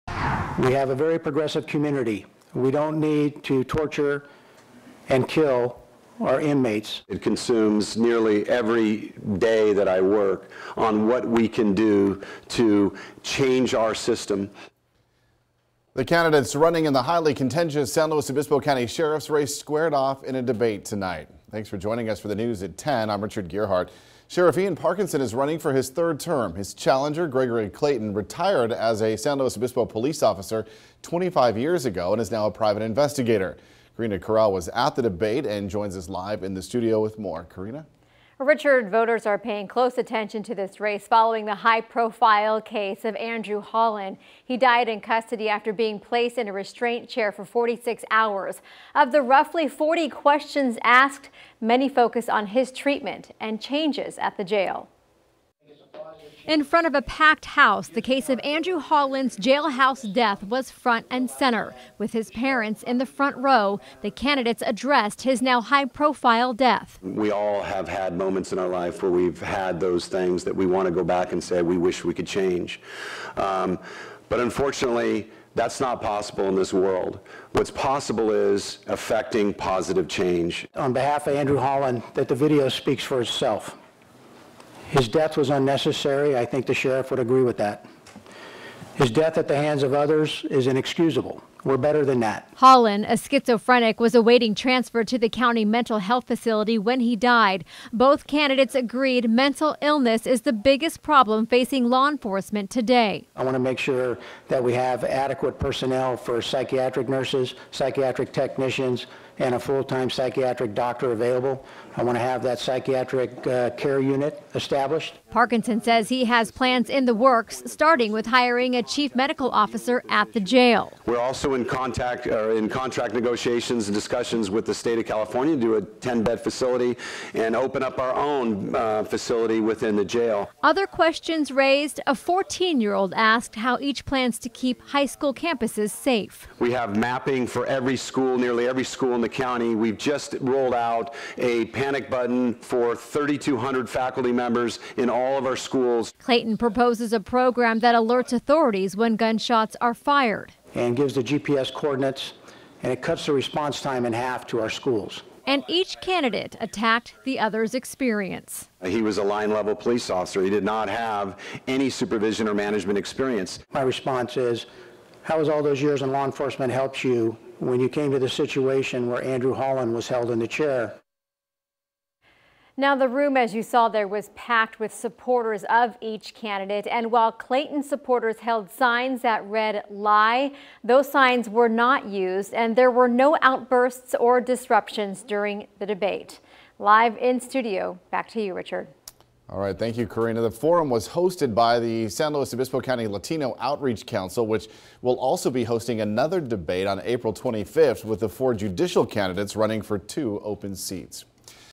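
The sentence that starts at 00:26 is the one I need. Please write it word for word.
His challenger, Gregory Clayton, retired as a San Luis Obispo police officer 25 years ago and is now a private investigator.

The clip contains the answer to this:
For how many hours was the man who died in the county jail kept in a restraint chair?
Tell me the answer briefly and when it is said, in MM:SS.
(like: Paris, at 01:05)
46, at 00:47.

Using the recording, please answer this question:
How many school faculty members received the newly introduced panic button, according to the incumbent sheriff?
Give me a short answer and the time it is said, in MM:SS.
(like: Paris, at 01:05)
3,200, at 02:22.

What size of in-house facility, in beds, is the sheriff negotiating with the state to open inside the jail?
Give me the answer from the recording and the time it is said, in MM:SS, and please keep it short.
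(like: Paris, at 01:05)
10-bed, at 02:05.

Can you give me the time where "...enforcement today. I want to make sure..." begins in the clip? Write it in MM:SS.
01:42.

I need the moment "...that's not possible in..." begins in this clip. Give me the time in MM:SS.
01:15.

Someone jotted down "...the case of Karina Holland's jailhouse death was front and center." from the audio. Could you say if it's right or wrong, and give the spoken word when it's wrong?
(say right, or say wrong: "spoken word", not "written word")
wrong: "Andrew", not "Karina".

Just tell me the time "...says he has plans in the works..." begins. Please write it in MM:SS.
01:55.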